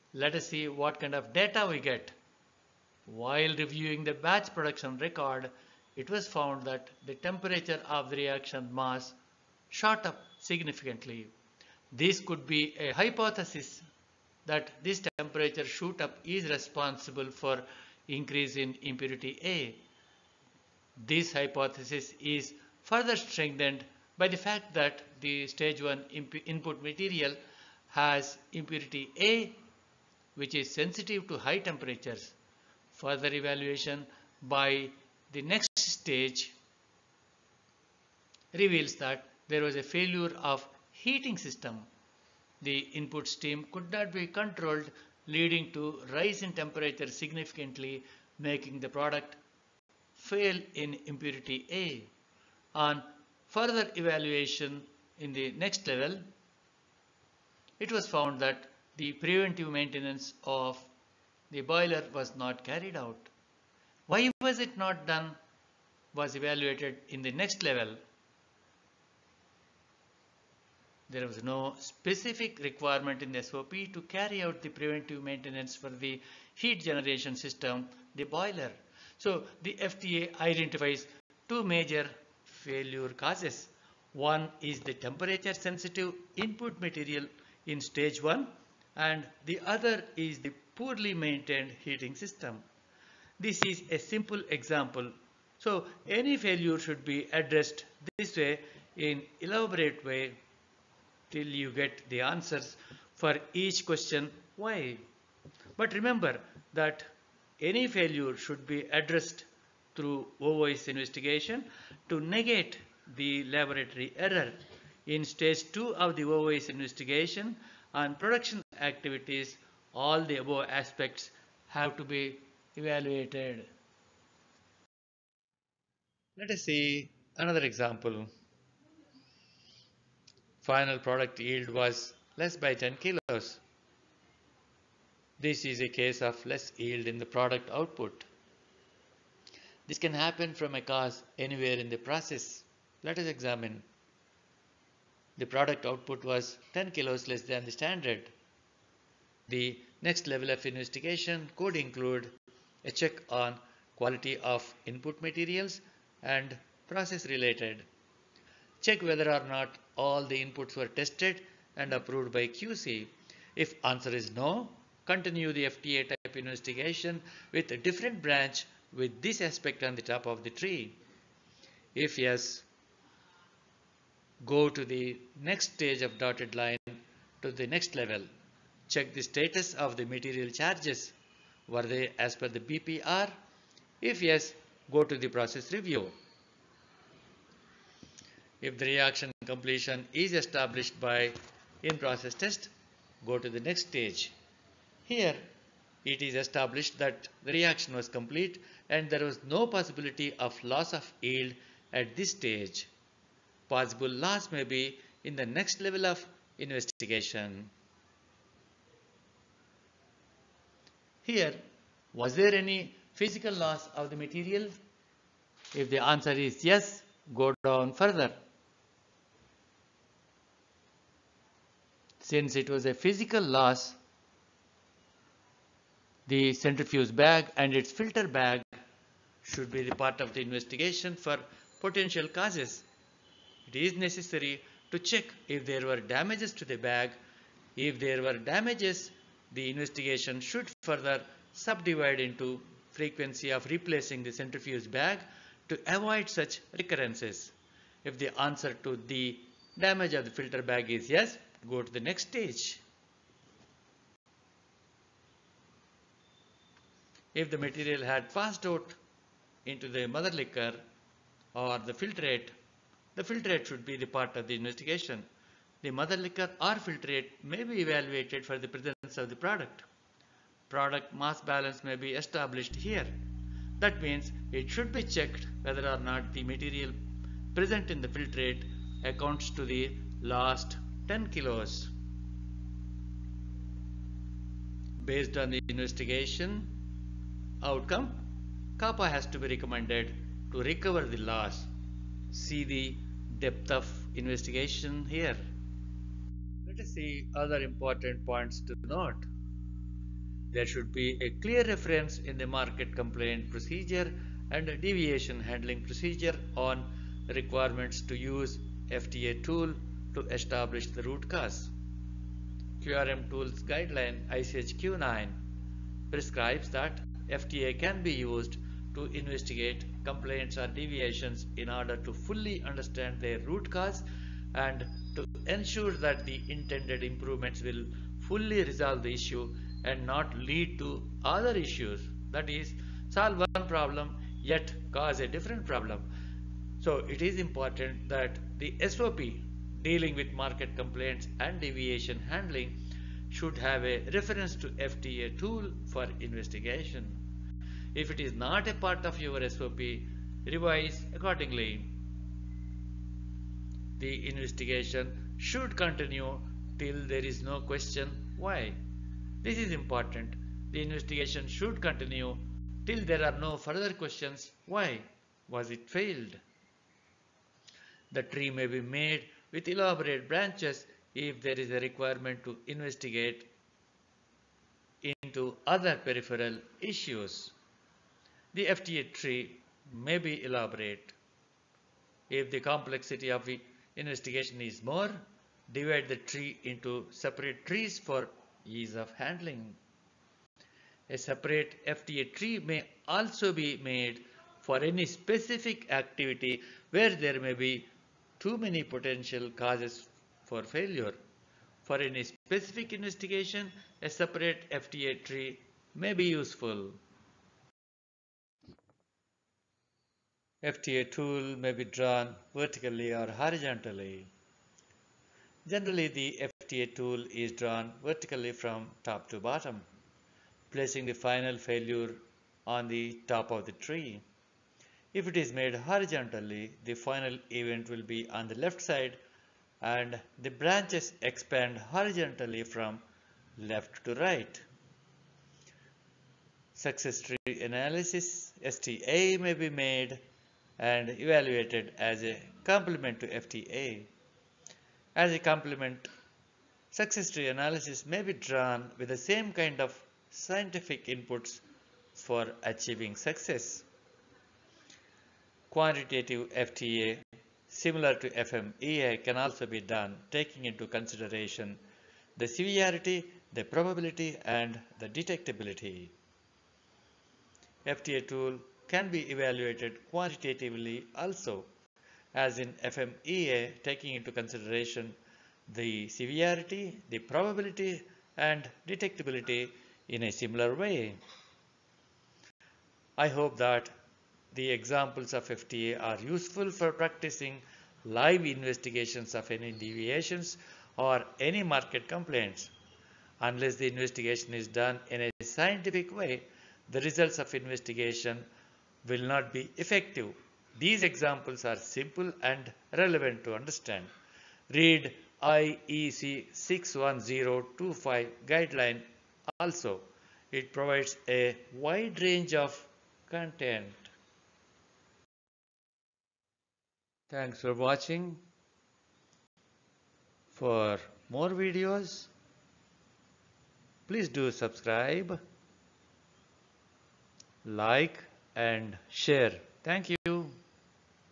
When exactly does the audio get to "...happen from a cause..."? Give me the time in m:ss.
2:20.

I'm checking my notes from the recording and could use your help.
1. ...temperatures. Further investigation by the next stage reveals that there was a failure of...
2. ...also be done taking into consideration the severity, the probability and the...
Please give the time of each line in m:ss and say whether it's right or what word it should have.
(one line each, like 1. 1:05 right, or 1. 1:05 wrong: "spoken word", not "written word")
1. 0:31 wrong: "evaluation", not "investigation"
2. 7:39 right.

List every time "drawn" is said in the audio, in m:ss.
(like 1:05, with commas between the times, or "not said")
6:51, 6:57, 7:28.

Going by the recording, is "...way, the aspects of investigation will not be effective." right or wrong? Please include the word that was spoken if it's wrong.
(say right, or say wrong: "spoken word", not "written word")
wrong: "results", not "aspects".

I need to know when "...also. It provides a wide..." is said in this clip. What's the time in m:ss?
8:29.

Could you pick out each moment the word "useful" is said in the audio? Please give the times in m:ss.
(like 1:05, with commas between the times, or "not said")
6:46, 8:06.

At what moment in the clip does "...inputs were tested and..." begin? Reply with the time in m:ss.
2:40.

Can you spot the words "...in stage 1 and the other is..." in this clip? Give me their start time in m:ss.
1:27.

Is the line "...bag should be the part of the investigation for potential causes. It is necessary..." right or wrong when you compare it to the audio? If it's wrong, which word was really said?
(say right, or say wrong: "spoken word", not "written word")
right.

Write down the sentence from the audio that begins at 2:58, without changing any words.
Check the status of the material charges.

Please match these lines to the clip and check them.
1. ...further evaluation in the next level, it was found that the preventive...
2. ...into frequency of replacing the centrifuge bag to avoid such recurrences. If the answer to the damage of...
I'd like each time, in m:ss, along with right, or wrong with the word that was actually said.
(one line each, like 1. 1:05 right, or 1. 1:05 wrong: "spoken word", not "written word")
1. 0:53 right
2. 4:02 right.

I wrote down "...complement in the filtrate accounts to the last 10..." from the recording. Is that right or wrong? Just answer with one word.
wrong.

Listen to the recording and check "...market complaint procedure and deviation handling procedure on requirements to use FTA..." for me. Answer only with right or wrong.
right.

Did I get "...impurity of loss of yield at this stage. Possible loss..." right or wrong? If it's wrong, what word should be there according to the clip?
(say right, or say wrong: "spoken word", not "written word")
wrong: "possibility", not "impurity".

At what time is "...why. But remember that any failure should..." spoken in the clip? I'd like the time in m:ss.
1:44.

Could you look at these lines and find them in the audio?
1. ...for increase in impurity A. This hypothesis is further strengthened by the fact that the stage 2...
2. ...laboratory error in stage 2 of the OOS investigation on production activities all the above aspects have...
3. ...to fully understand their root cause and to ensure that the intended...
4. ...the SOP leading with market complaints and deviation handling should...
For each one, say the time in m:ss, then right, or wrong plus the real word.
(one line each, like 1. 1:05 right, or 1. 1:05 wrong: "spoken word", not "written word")
1. 0:17 wrong: "1", not "2"
2. 1:53 right
3. 5:21 right
4. 5:38 wrong: "dealing", not "leading".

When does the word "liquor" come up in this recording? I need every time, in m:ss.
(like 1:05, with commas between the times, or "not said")
4:20, 4:26.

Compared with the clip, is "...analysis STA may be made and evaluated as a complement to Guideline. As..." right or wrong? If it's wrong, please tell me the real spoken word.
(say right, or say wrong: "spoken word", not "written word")
wrong: "FTA", not "Guideline".